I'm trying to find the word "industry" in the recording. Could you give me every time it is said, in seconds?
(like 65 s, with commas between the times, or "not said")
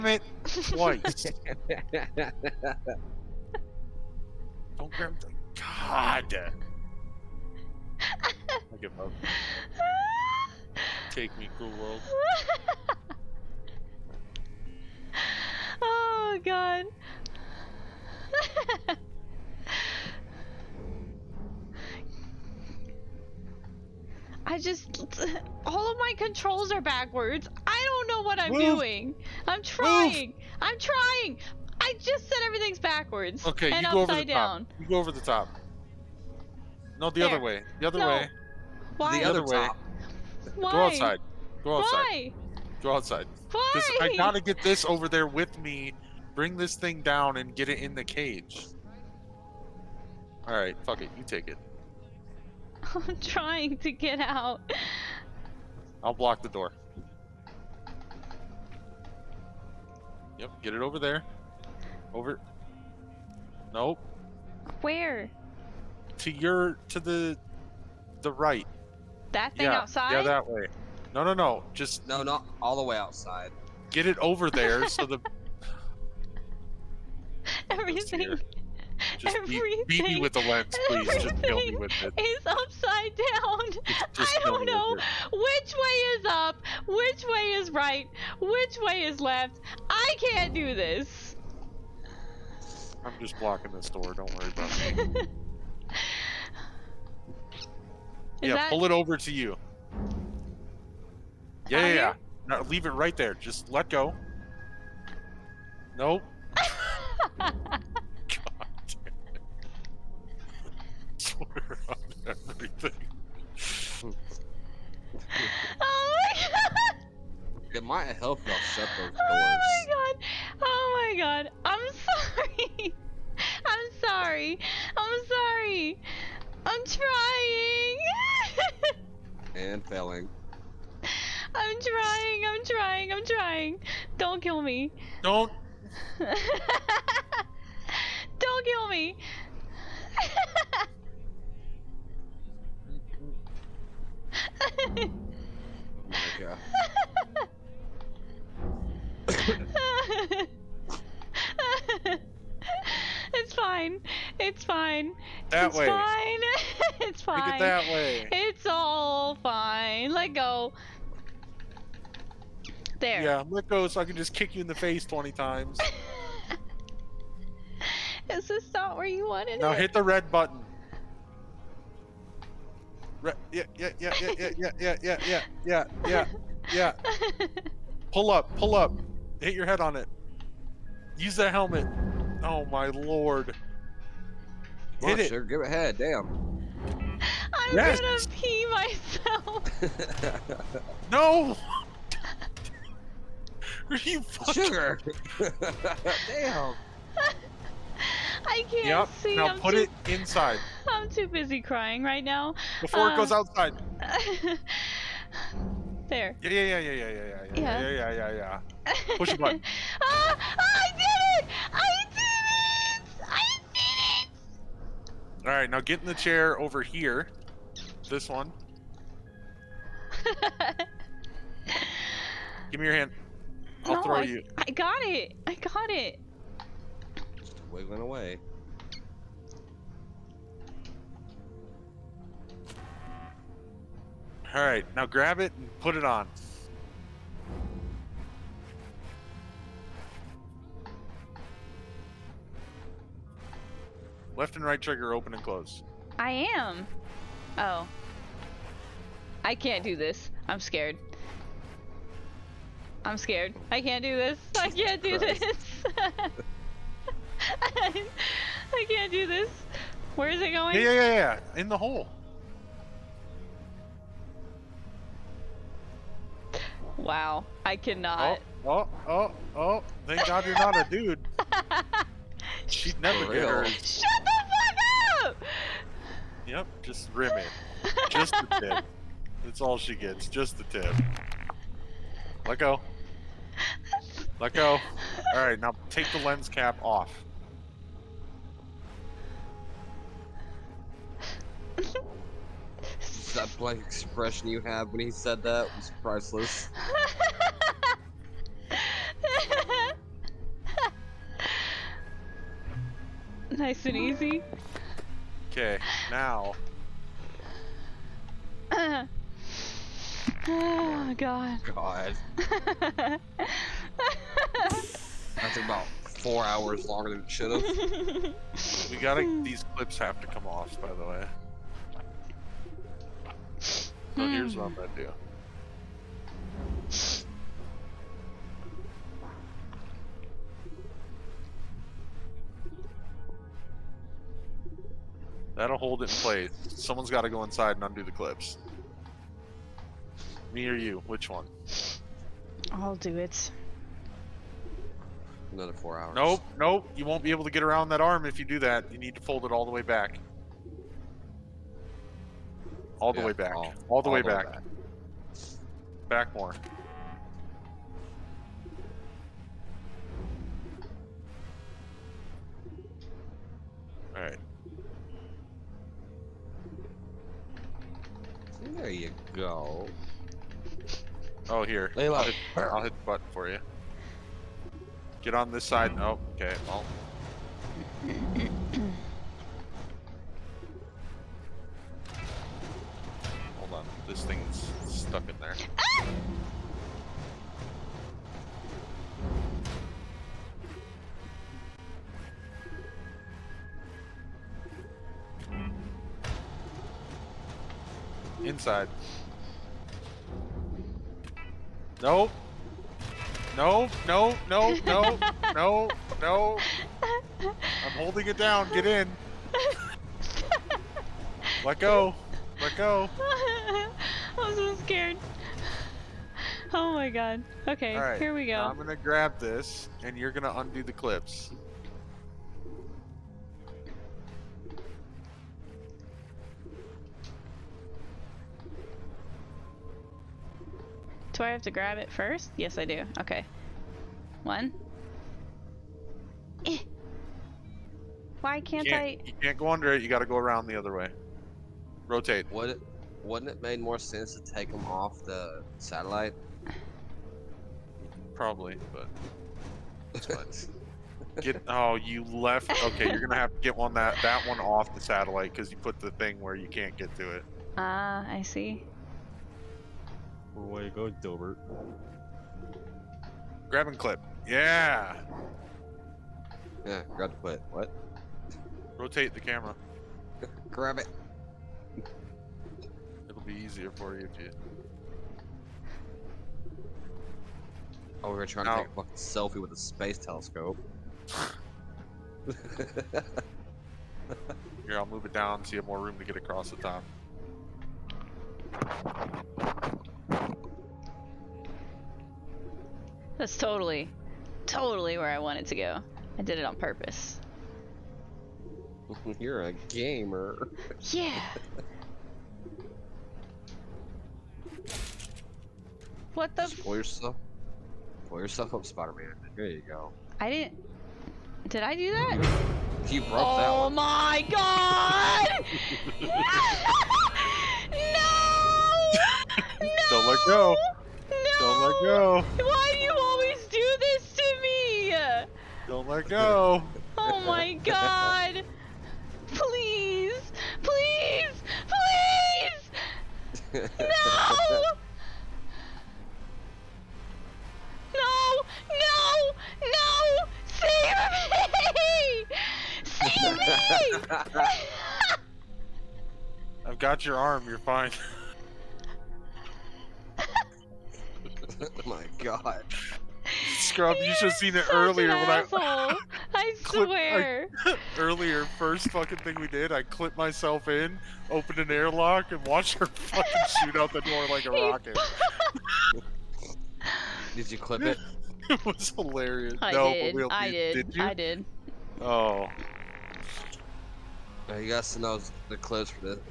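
not said.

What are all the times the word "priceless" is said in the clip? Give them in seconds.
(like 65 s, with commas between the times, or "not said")
296 s.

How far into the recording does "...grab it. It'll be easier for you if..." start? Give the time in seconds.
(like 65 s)
470 s.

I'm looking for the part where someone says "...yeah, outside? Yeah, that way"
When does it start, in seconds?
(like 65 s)
69 s.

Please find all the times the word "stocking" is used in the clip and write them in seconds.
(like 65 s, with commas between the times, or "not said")
not said.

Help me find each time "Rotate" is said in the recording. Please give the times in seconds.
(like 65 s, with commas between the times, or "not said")
442 s, 468 s.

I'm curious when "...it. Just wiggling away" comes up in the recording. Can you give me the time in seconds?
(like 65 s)
225 s.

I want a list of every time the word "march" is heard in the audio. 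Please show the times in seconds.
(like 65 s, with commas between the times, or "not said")
not said.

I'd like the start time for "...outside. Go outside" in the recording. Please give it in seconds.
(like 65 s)
40 s.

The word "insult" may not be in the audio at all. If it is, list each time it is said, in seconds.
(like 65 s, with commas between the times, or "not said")
not said.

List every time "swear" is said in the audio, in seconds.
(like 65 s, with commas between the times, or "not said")
111 s, 556 s.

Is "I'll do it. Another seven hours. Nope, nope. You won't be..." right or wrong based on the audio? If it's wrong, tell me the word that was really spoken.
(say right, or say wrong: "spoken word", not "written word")
wrong: "four", not "seven".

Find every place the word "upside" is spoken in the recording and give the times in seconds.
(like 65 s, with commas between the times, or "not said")
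34 s, 82 s.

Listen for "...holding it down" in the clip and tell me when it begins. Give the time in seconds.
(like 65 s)
407 s.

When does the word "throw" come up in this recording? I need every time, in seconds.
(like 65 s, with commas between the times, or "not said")
224 s.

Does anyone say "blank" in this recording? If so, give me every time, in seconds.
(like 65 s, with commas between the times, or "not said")
293 s.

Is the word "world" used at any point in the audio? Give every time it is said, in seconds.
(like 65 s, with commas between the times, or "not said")
11 s.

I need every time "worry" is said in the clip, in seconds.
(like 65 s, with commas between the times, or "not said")
94 s.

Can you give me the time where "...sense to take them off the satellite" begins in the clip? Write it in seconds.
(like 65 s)
443 s.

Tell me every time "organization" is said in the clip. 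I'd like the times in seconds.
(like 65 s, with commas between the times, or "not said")
not said.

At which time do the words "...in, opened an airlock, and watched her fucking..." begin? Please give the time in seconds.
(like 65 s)
560 s.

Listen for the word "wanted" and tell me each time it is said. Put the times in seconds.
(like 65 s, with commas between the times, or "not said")
169 s, 495 s.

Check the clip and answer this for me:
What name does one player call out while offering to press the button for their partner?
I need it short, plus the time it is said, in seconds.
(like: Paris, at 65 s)
Layla, at 371 s.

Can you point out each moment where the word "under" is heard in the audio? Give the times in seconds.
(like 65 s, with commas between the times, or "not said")
439 s.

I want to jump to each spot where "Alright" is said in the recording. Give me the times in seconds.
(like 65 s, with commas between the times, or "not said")
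50 s, 285 s, 364 s.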